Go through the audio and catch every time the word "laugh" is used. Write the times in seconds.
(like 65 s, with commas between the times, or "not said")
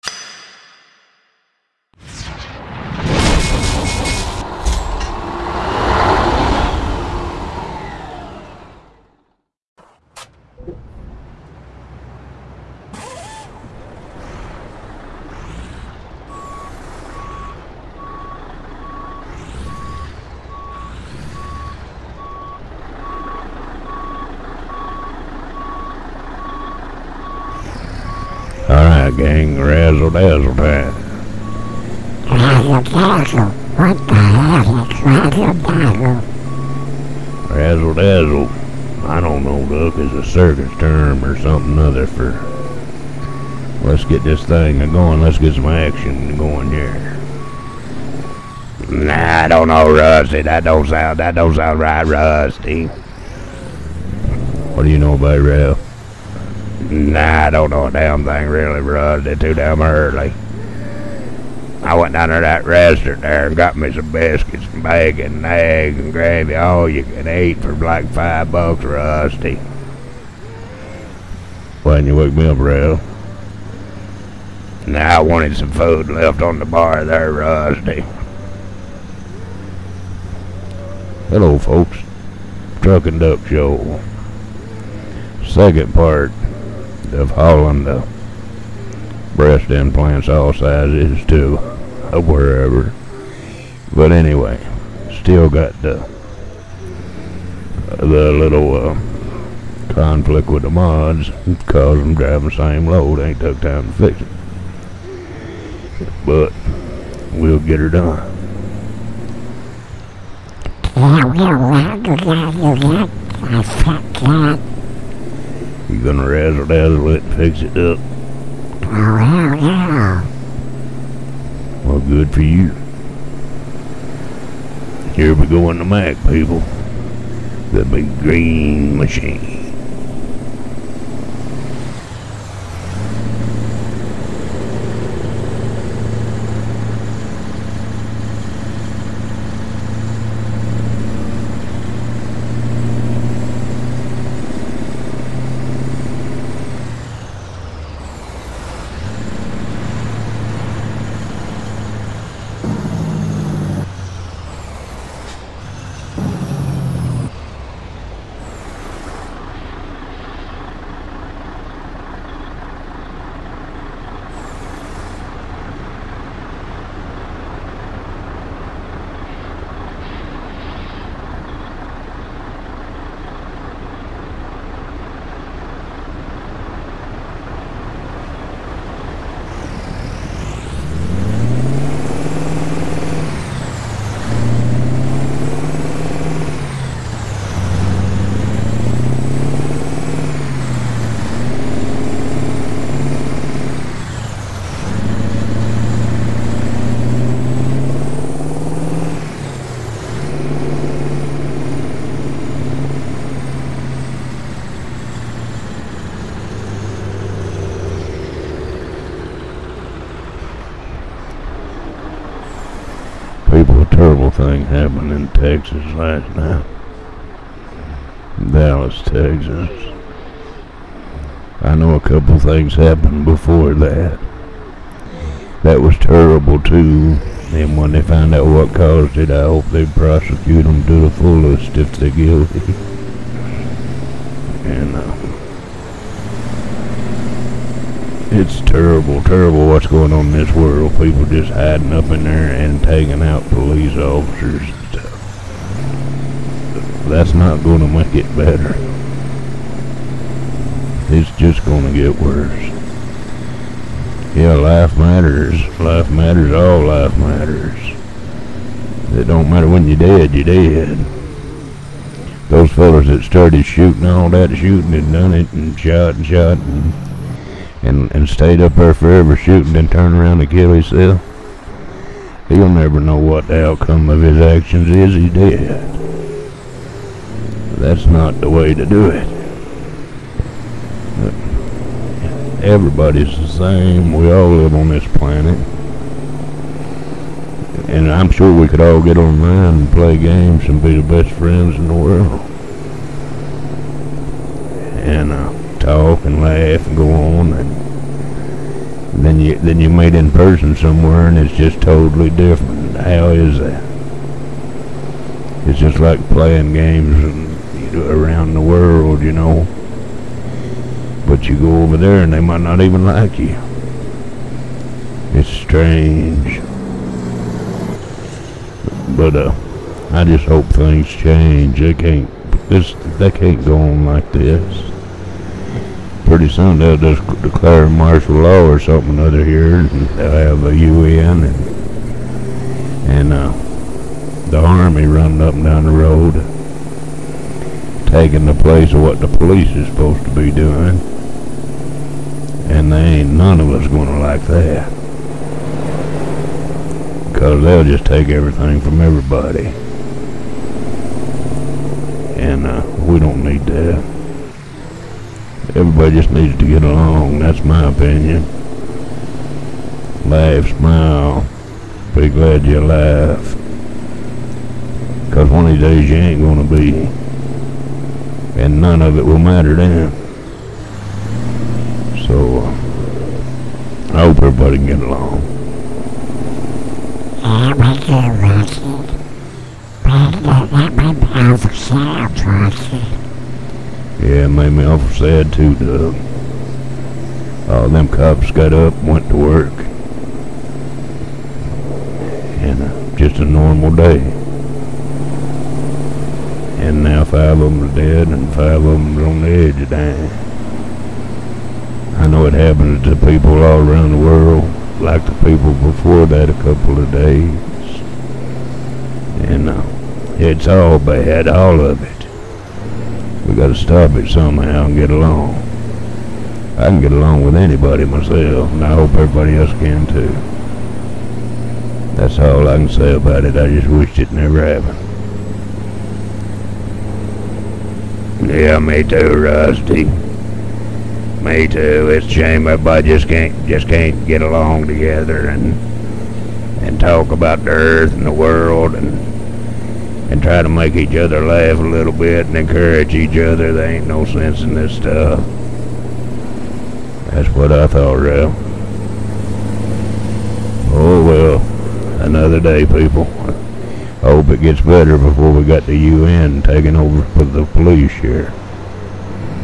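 296 s, 360 s, 441 s.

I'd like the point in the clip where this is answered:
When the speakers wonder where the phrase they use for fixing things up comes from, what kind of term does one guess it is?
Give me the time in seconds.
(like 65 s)
40 s.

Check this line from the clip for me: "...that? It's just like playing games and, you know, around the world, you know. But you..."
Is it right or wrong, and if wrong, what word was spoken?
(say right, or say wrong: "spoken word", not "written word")
right.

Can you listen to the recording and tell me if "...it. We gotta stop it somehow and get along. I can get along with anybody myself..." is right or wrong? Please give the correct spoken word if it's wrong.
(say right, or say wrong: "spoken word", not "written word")
right.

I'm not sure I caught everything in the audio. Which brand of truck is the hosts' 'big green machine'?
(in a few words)
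Mack.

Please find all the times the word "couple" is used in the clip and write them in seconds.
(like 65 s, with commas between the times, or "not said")
221 s, 406 s.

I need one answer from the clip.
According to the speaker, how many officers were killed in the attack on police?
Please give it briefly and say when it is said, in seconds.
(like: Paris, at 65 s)
5, at 397 s.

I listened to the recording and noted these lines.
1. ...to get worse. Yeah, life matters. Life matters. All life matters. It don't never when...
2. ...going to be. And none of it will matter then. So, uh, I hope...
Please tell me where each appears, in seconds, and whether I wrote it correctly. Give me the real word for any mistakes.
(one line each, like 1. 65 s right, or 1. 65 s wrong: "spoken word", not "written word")
1. 251 s wrong: "matter", not "never"
2. 366 s right.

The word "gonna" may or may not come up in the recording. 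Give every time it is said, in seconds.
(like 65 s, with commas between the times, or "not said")
116 s, 343 s.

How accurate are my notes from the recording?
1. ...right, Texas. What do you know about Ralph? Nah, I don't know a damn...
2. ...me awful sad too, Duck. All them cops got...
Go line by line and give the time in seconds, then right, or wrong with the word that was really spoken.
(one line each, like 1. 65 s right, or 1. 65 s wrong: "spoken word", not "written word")
1. 51 s wrong: "Rusty", not "Texas"
2. 384 s wrong: "Doug", not "Duck".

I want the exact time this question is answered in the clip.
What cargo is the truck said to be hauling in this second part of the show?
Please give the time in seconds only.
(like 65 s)
89 s.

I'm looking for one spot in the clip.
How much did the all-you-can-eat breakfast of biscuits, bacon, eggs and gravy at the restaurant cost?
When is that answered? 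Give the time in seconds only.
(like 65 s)
68 s.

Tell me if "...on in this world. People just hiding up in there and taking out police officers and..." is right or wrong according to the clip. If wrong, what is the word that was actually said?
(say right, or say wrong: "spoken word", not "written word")
right.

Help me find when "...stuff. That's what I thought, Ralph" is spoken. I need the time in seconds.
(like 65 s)
444 s.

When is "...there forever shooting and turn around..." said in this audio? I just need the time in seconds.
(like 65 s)
268 s.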